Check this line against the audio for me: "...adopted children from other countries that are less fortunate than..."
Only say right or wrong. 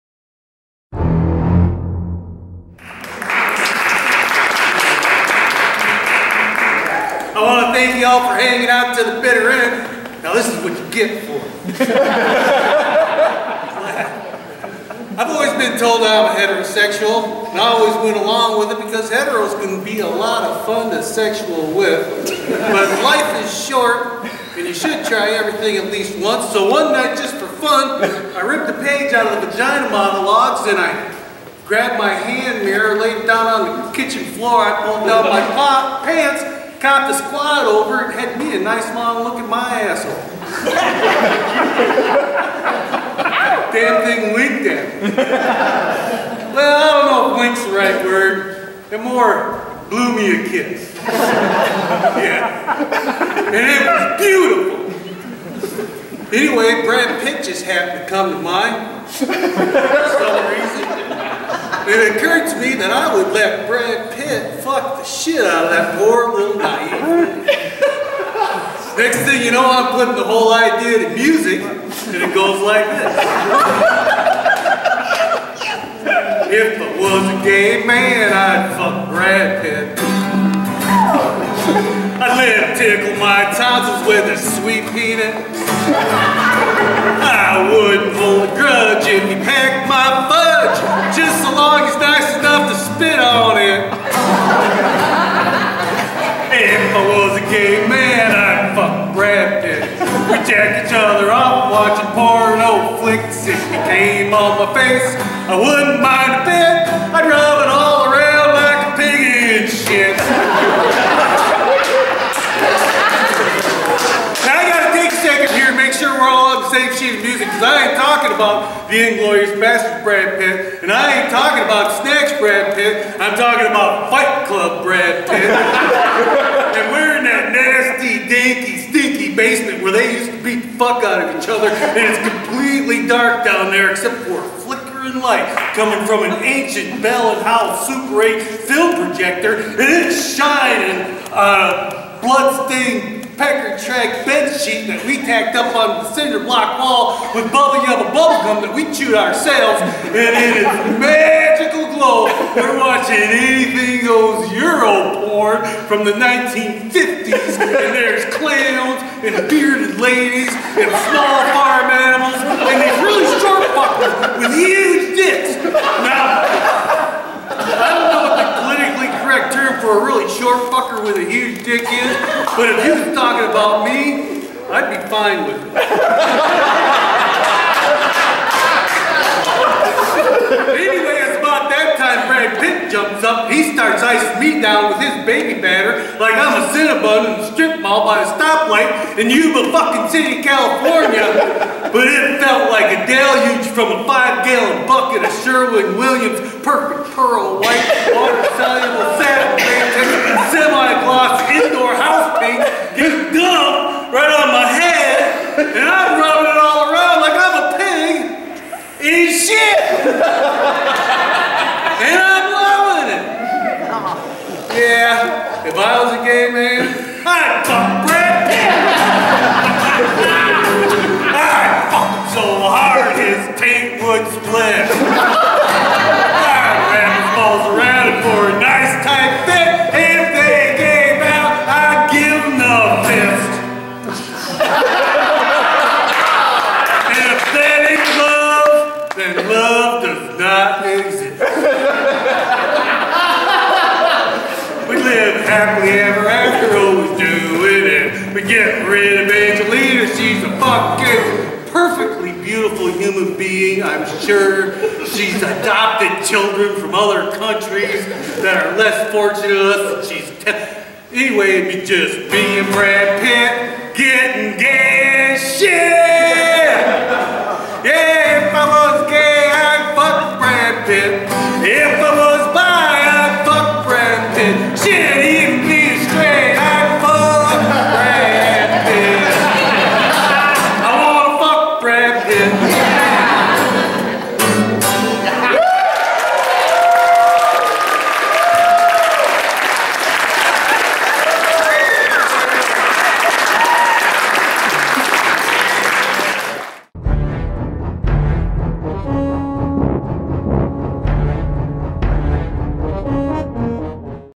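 right.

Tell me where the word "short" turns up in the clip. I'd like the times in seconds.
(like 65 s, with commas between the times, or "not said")
23 s, 163 s, 170 s.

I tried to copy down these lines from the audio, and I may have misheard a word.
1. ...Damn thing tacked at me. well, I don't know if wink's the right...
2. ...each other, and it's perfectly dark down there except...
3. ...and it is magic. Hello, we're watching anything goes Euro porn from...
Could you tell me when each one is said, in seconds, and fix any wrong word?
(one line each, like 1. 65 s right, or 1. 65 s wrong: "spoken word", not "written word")
1. 43 s wrong: "winked", not "tacked"
2. 131 s wrong: "completely", not "perfectly"
3. 150 s right.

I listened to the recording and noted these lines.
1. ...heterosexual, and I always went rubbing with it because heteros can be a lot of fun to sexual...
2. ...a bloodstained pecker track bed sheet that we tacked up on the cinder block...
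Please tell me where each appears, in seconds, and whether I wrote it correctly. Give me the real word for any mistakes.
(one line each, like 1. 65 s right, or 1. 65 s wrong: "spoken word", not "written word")
1. 16 s wrong: "along", not "rubbing"
2. 141 s right.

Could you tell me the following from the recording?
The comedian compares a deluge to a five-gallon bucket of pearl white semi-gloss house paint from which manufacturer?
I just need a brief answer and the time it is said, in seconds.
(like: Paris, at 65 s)
Sherwin-Williams, at 195 s.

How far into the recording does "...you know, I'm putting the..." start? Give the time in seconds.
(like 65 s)
69 s.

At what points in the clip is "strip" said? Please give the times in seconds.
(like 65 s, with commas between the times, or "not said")
187 s.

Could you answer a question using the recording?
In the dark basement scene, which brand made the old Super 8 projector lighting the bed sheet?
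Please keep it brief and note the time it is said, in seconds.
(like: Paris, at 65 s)
Bell and Howell, at 137 s.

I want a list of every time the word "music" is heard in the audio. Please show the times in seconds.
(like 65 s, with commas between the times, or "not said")
71 s, 117 s.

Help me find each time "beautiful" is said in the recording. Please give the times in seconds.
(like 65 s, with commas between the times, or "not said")
54 s, 252 s.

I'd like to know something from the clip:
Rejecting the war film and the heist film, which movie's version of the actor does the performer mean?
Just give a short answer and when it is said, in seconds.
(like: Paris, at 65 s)
Fight Club, at 124 s.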